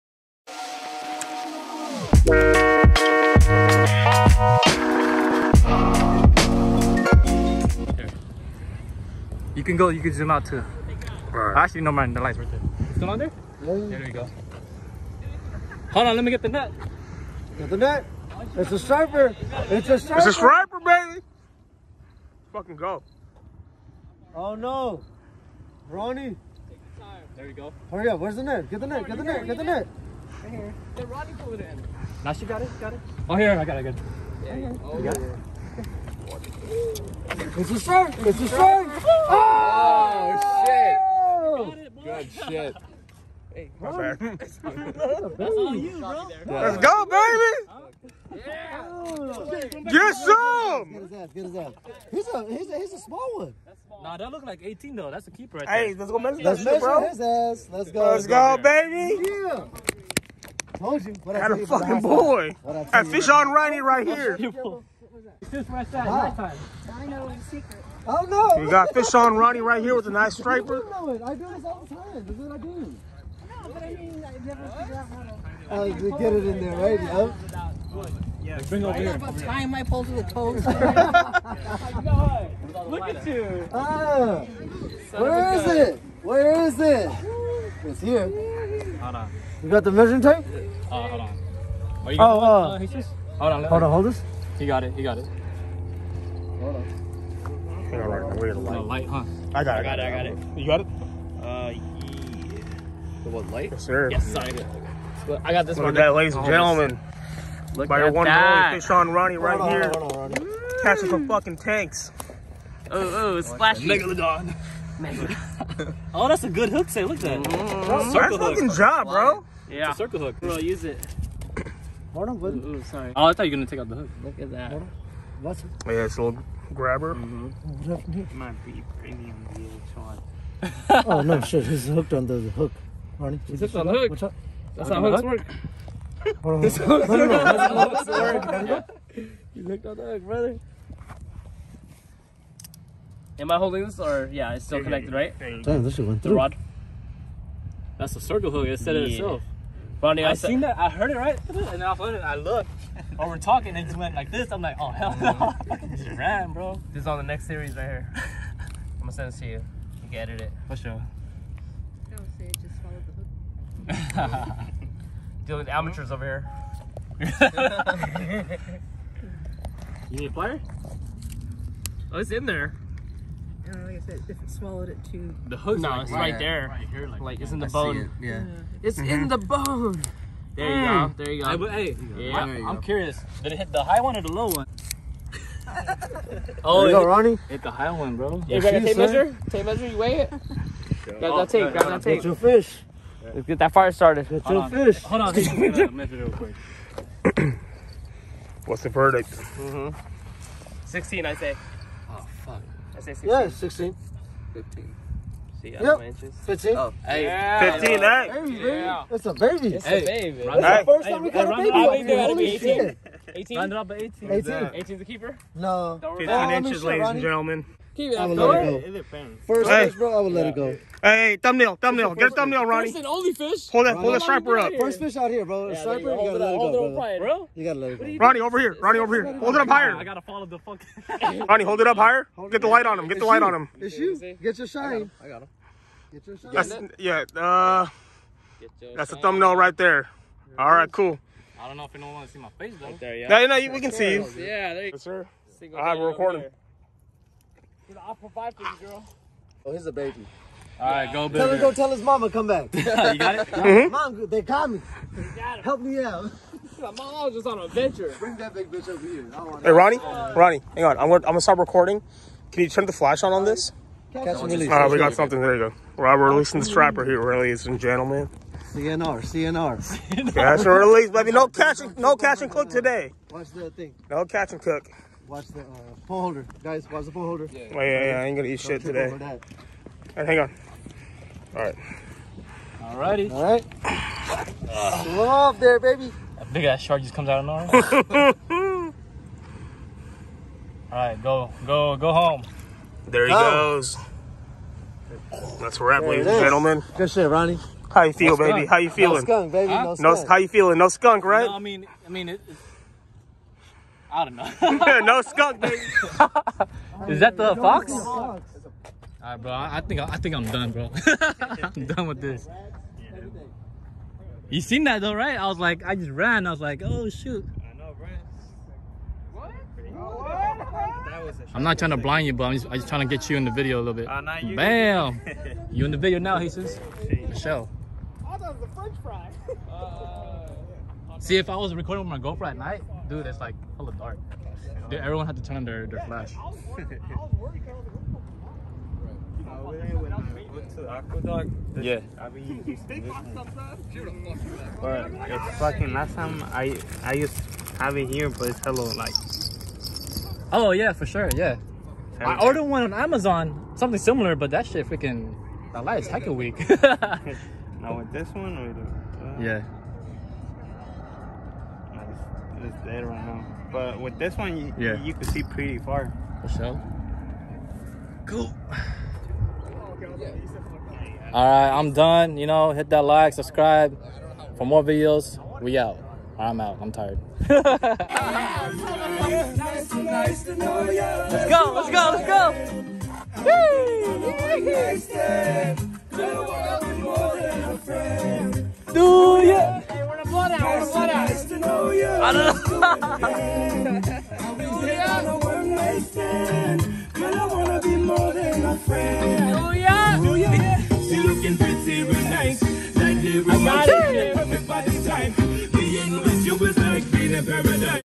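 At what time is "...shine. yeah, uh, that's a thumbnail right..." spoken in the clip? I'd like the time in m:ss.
3:56.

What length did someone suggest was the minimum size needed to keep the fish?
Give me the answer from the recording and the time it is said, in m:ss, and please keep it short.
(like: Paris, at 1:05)
18, at 3:34.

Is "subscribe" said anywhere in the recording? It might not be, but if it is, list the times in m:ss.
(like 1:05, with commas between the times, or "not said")
6:13.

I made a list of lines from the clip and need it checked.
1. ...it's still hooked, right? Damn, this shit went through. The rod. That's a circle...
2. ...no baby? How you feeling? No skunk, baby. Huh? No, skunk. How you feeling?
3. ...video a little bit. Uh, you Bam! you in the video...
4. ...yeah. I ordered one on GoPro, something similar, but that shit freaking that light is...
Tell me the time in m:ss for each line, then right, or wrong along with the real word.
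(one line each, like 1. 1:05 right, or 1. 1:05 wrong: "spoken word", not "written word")
1. 2:24 wrong: "connected", not "hooked"
2. 4:58 right
3. 5:23 right
4. 5:51 wrong: "Amazon", not "GoPro".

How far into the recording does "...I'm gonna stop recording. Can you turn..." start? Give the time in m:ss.
4:21.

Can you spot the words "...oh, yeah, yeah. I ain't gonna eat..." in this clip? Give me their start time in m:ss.
4:37.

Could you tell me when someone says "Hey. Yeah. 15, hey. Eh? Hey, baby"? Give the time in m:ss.
3:27.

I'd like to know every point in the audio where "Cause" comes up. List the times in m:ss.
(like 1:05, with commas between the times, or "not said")
4:07.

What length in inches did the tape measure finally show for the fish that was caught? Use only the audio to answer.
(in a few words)
15.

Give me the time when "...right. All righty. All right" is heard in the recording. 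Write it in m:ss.
4:41.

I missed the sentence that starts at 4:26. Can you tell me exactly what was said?
Right, we're releasing this striper here, ladies and gentlemen.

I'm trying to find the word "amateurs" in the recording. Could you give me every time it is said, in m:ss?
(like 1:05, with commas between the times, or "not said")
2:45.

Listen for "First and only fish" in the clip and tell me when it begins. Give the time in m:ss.
3:42.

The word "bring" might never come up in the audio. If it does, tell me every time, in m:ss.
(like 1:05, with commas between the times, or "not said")
1:18, 4:18.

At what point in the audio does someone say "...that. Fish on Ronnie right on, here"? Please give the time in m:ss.
1:48.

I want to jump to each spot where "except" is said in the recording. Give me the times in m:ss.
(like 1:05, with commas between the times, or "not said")
not said.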